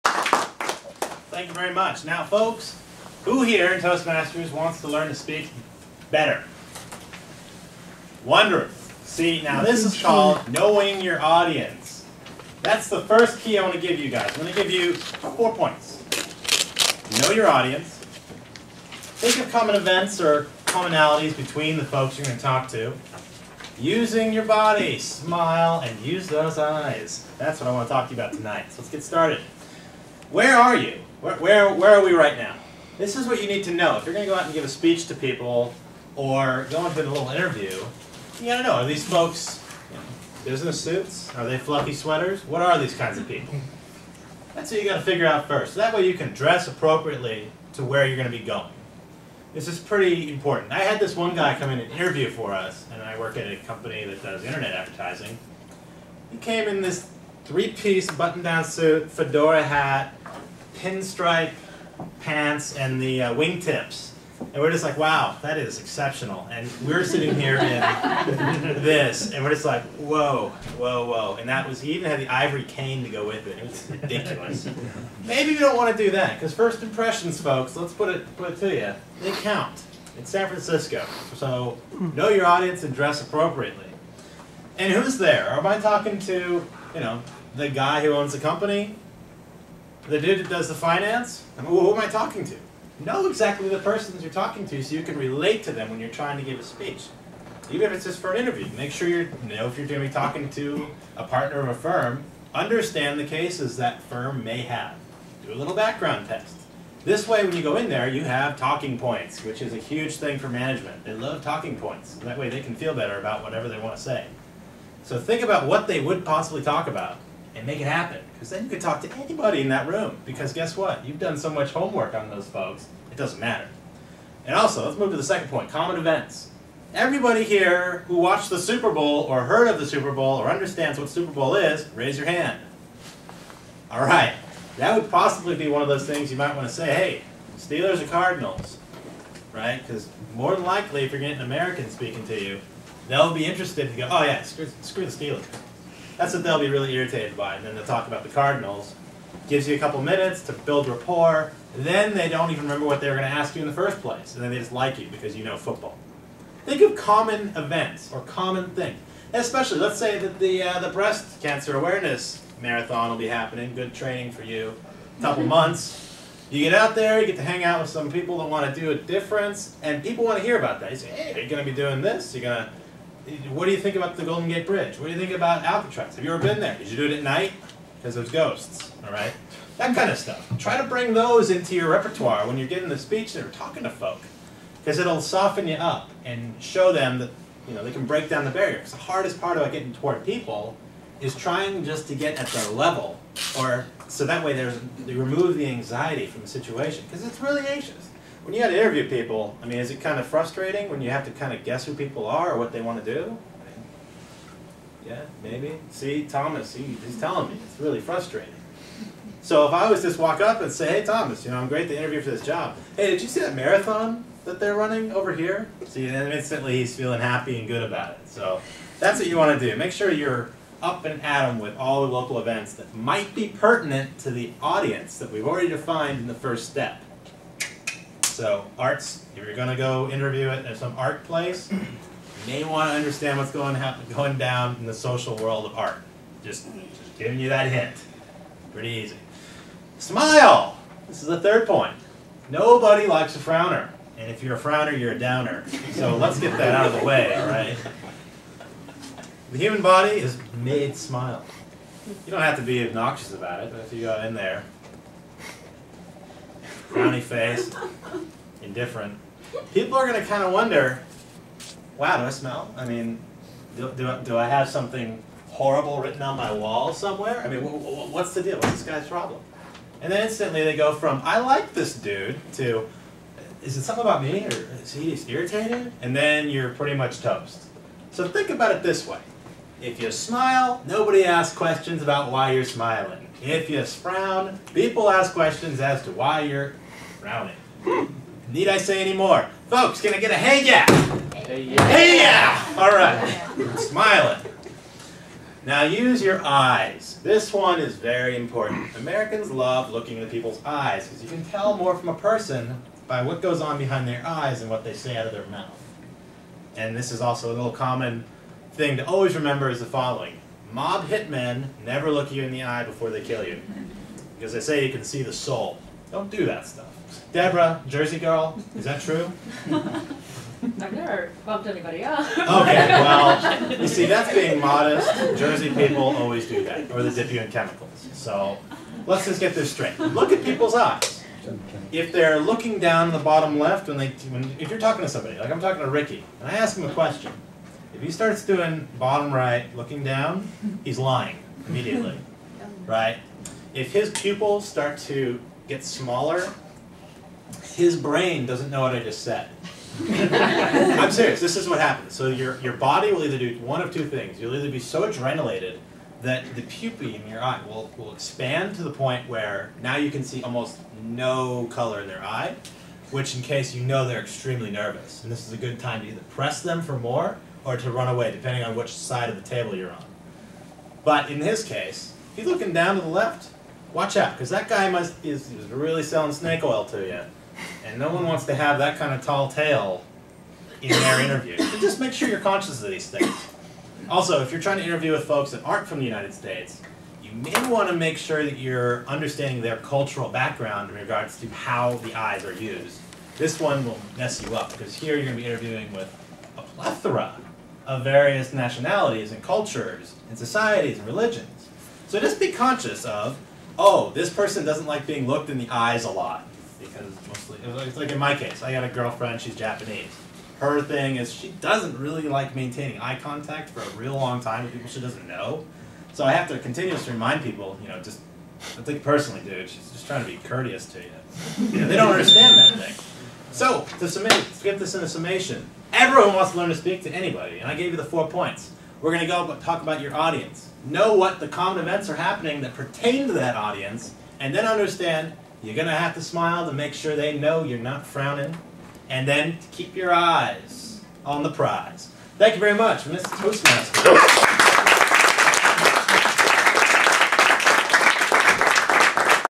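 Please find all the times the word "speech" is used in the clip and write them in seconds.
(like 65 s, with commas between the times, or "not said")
34 s, 96 s, 182 s.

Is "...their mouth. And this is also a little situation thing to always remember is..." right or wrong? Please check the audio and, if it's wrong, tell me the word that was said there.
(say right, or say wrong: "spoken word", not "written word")
wrong: "common", not "situation".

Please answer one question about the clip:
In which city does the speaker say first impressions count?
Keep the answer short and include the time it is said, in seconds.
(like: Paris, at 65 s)
San Francisco, at 80 s.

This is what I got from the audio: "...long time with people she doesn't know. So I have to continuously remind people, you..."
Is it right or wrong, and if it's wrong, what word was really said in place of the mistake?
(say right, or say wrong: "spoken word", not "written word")
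right.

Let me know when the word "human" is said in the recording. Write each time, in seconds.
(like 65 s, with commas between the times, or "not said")
249 s.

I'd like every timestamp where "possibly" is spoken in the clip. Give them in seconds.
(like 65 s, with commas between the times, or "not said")
116 s, 135 s.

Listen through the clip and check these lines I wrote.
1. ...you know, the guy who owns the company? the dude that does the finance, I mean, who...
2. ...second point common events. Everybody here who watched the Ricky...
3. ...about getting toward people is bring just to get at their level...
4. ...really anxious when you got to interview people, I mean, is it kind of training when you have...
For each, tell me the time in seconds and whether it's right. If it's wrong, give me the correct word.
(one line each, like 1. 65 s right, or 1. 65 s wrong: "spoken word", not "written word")
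1. 86 s right
2. 125 s wrong: "Super", not "Ricky"
3. 189 s wrong: "trying", not "bring"
4. 197 s wrong: "frustrating", not "training".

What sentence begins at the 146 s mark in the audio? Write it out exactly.
That's what they'll be really irritated by.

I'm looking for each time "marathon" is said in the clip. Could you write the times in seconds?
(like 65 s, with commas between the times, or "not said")
162 s, 213 s.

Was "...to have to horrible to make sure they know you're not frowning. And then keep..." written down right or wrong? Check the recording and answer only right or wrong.
wrong.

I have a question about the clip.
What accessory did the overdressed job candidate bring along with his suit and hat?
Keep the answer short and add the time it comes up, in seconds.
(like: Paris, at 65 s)
Ivory cane, at 72 s.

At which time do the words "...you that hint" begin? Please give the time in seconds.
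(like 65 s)
237 s.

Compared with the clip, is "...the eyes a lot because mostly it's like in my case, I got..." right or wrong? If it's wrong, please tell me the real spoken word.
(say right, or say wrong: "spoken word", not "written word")
right.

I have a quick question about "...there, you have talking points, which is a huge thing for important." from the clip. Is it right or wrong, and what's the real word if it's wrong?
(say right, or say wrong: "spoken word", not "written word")
wrong: "management", not "important".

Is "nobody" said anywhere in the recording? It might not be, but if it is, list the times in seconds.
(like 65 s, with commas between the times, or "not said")
242 s, 280 s.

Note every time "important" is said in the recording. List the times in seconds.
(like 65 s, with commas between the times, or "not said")
50 s, 298 s.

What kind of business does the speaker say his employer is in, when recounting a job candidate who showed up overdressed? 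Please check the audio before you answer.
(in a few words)
Internet advertising.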